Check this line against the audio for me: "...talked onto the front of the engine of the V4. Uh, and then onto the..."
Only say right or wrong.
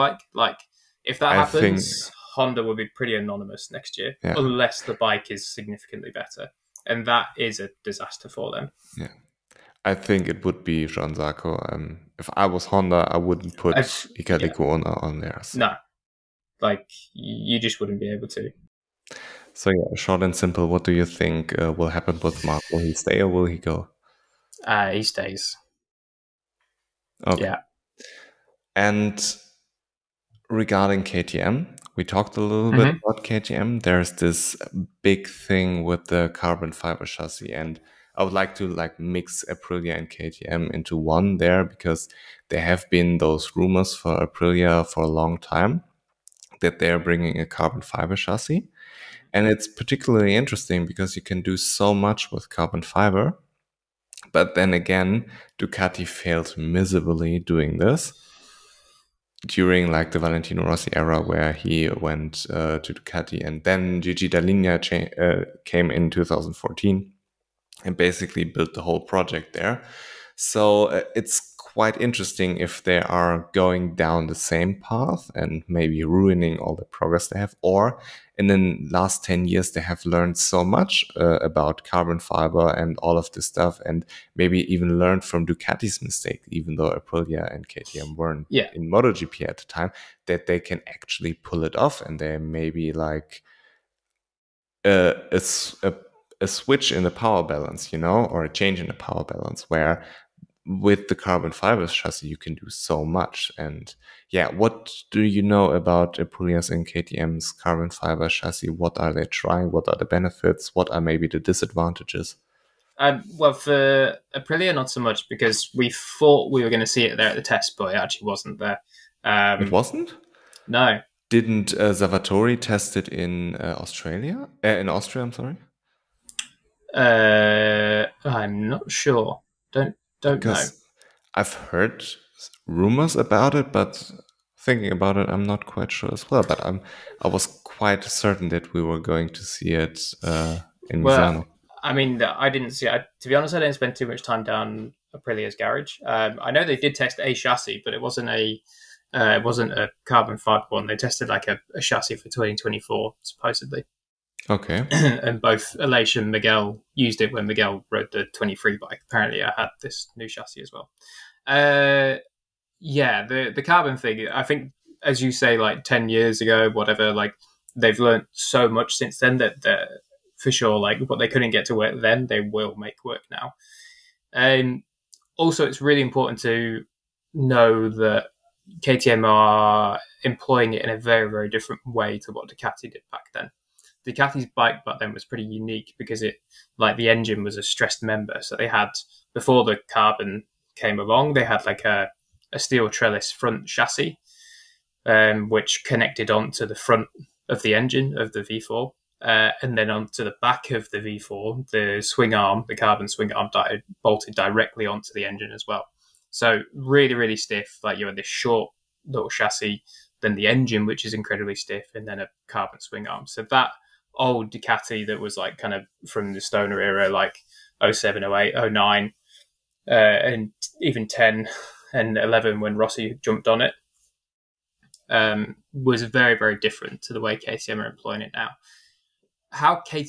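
wrong.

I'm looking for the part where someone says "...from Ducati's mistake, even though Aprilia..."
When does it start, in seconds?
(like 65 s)
85 s.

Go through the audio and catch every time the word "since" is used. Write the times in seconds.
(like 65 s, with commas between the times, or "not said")
168 s.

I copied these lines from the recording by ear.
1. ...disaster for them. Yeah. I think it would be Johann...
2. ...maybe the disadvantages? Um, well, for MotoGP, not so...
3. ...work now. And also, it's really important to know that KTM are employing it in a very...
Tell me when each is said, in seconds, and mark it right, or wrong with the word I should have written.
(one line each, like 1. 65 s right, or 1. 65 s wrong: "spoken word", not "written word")
1. 7 s right
2. 111 s wrong: "Aprilia", not "MotoGP"
3. 173 s right.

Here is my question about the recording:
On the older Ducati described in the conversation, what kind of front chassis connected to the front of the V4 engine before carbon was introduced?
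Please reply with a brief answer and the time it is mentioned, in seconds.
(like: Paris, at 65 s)
steel trellis, at 192 s.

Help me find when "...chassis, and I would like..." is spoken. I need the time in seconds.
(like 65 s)
37 s.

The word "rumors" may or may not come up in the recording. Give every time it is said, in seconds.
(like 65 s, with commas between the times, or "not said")
43 s, 132 s.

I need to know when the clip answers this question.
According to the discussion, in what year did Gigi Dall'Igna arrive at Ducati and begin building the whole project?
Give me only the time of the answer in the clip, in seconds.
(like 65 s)
66 s.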